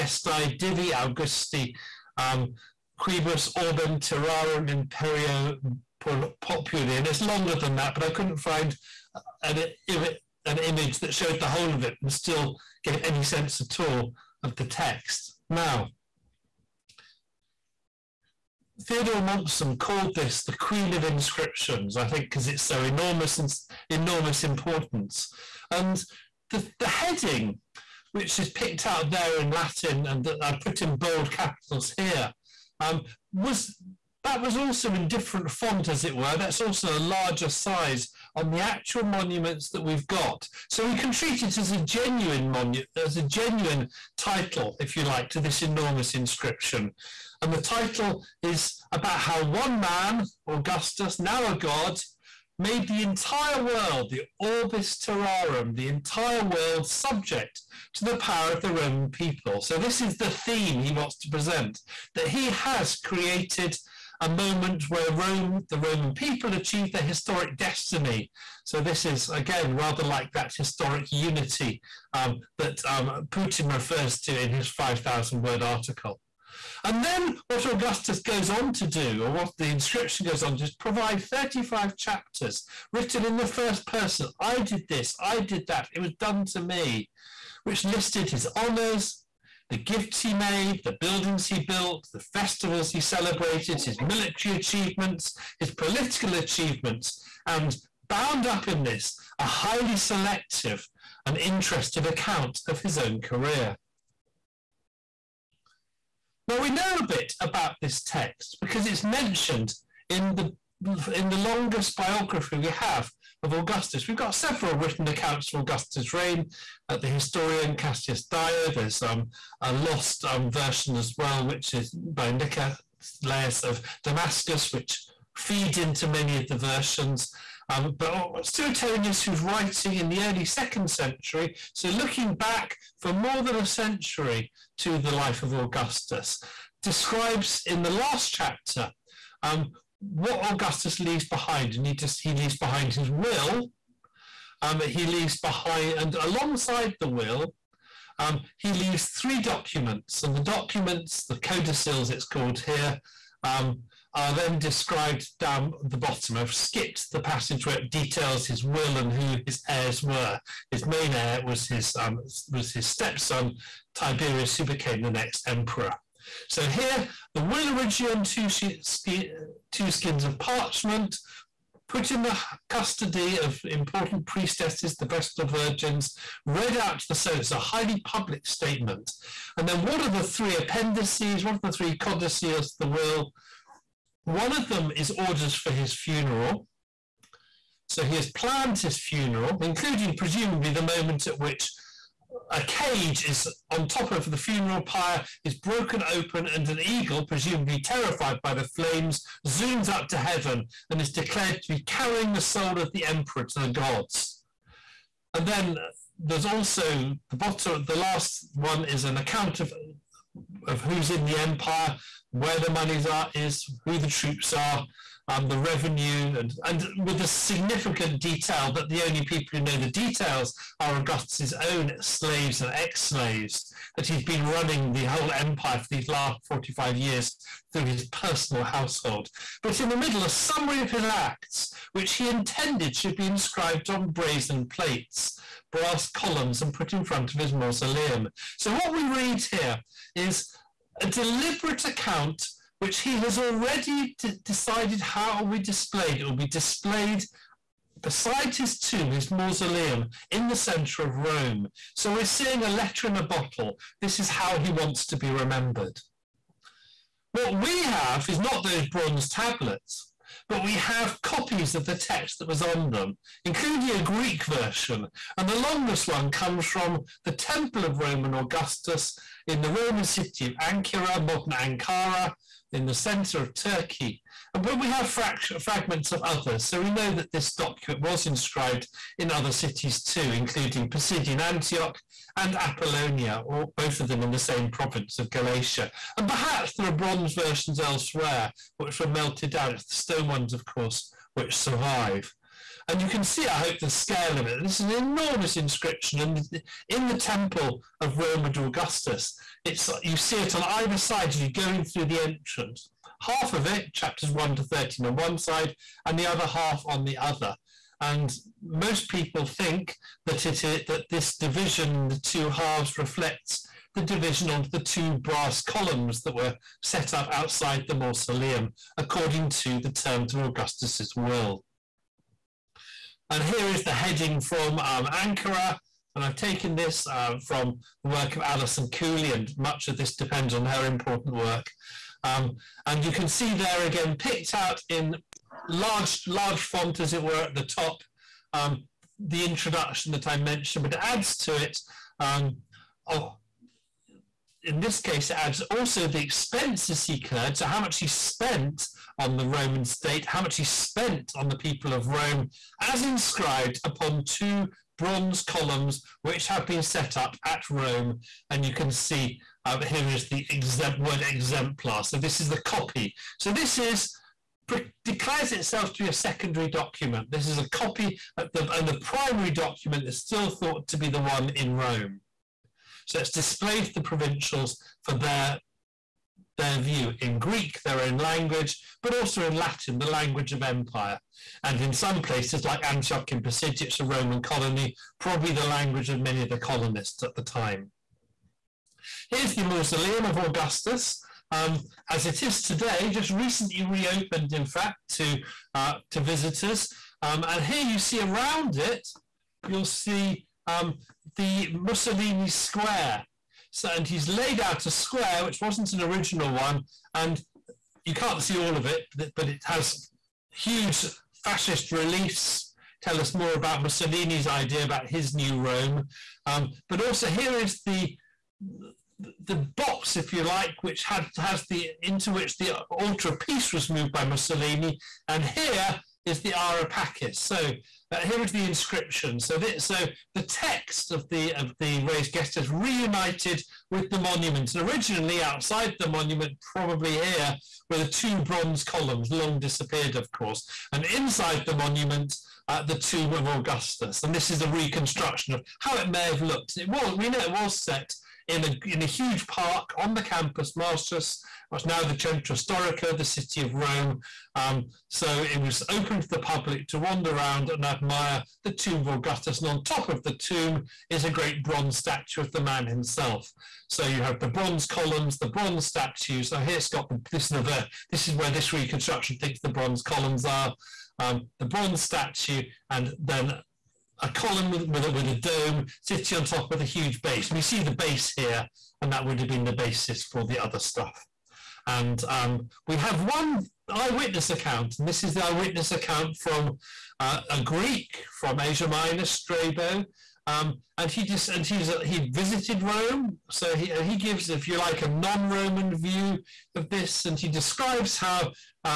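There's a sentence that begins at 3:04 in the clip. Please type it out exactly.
One of them is orders for his funeral.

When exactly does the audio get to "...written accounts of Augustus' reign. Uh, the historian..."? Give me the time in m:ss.
1:54.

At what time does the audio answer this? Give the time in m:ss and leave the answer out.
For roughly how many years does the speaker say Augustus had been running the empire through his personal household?
3:46.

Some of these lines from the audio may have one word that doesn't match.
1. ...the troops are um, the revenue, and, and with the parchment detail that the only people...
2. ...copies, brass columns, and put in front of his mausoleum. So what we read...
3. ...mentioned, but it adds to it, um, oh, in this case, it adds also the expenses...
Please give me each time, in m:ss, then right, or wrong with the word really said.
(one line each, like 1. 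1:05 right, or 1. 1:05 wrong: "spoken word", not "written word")
1. 3:33 wrong: "significant", not "parchment"
2. 3:54 wrong: "plates", not "copies"
3. 5:40 right.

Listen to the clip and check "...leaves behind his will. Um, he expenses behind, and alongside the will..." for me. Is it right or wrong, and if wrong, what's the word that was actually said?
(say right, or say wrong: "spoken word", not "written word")
wrong: "leaves", not "expenses".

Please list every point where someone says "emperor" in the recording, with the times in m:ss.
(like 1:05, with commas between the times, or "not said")
2:45, 3:23.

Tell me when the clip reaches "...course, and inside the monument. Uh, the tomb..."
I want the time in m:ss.
7:20.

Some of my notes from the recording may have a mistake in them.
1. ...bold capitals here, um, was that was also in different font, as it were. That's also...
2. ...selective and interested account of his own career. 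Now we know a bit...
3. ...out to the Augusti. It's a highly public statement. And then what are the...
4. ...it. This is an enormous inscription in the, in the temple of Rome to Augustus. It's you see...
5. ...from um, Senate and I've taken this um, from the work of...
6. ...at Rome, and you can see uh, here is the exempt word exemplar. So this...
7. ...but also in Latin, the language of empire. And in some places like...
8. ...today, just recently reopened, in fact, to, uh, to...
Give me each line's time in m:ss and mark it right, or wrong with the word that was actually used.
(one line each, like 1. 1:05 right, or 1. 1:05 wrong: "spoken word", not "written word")
1. 0:30 right
2. 1:39 right
3. 2:56 wrong: "Senate", not "Augusti"
4. 4:54 right
5. 5:24 wrong: "Ankara", not "Senate"
6. 5:57 right
7. 6:19 right
8. 6:32 right.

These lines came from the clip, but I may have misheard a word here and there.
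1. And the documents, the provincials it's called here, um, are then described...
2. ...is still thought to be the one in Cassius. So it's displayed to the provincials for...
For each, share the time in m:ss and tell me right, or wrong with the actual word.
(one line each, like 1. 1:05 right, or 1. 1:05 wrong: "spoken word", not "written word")
1. 2:30 wrong: "codicils", not "provincials"
2. 6:10 wrong: "Rome", not "Cassius".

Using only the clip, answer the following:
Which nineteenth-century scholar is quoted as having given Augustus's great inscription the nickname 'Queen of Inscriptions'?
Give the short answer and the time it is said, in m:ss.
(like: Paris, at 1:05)
Theodore Mommsen, at 0:18.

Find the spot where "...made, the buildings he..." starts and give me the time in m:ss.
1:30.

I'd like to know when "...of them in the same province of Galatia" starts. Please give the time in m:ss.
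4:43.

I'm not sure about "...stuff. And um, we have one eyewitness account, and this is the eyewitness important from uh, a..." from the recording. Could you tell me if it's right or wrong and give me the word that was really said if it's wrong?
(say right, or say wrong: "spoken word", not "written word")
wrong: "account", not "important".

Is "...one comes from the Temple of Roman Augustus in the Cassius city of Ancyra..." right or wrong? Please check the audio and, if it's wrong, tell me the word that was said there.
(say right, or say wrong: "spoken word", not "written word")
wrong: "Roman", not "Cassius".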